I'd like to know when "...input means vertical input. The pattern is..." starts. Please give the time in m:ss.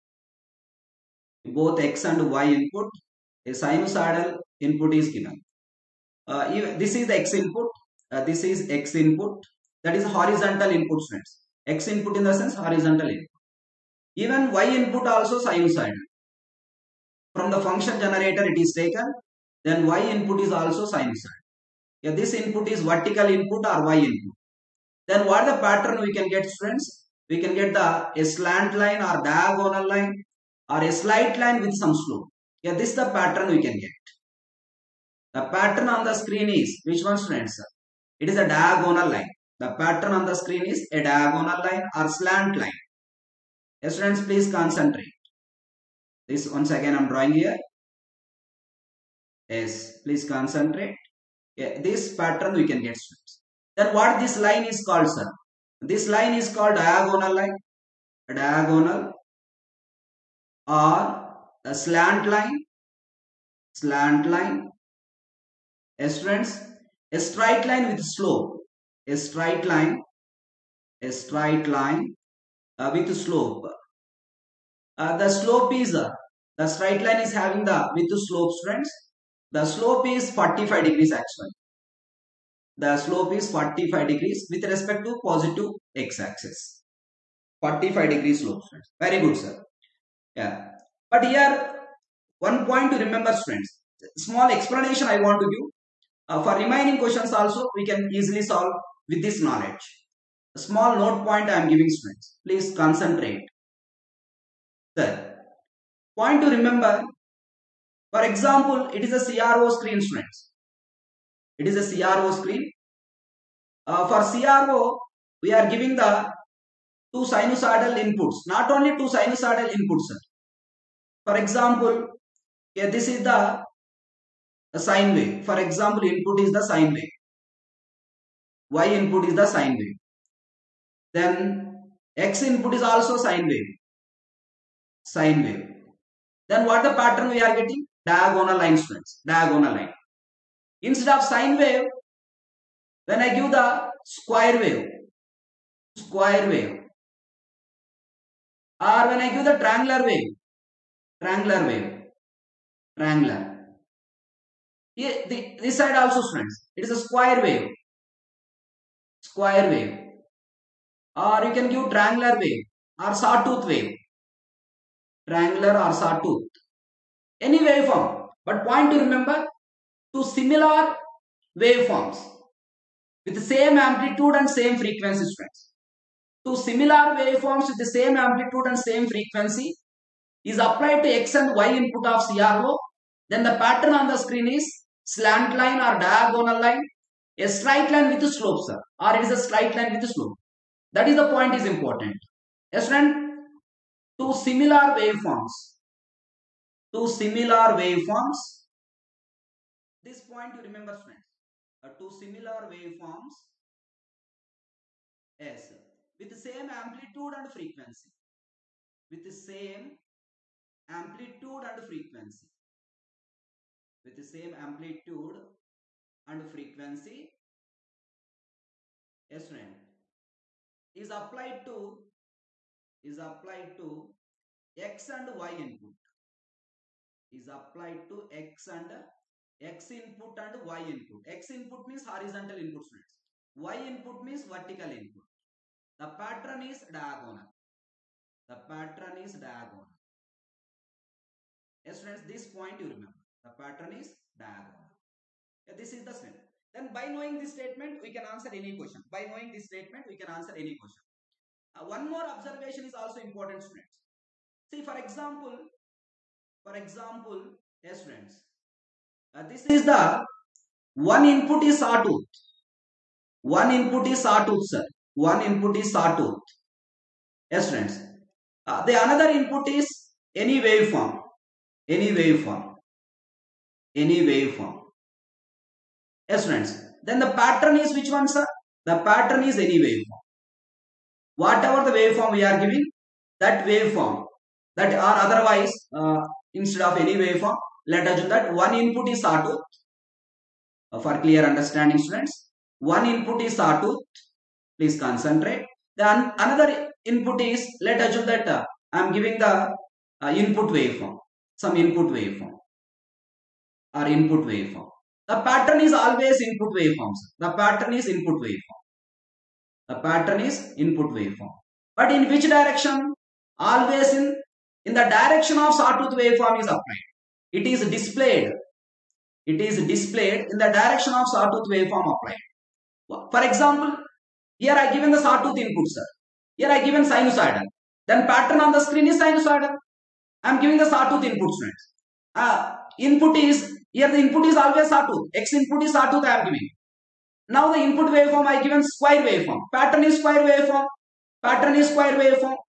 3:53.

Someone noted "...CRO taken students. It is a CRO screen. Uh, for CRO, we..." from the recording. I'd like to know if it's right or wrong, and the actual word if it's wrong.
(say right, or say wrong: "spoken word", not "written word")
wrong: "screen", not "taken".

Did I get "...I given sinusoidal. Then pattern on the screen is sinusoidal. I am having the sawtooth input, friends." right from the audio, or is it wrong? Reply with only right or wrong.
wrong.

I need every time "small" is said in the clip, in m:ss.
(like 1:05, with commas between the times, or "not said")
1:34, 1:40.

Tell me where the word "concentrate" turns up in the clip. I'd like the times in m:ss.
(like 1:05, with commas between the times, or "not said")
0:44, 0:50, 1:42, 4:54.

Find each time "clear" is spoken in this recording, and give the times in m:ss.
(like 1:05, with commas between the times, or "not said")
4:51.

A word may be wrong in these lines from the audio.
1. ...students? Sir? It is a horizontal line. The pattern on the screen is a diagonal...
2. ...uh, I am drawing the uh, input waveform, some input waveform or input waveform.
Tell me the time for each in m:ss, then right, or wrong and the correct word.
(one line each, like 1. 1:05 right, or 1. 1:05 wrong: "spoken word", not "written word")
1. 0:37 wrong: "diagonal", not "horizontal"
2. 4:58 wrong: "giving", not "drawing".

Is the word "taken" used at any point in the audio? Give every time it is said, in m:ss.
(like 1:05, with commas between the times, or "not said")
0:18.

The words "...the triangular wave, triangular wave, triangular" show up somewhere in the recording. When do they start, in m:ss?
2:29.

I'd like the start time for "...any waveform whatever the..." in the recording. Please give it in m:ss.
4:39.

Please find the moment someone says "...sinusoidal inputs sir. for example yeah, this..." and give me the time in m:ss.
1:59.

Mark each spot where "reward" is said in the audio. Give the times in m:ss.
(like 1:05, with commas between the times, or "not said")
not said.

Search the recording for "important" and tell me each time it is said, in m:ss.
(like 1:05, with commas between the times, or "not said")
3:11, 4:13.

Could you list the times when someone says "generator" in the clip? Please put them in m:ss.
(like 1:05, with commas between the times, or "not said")
0:17.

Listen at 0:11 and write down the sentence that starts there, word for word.
x input in the sense horizontal input.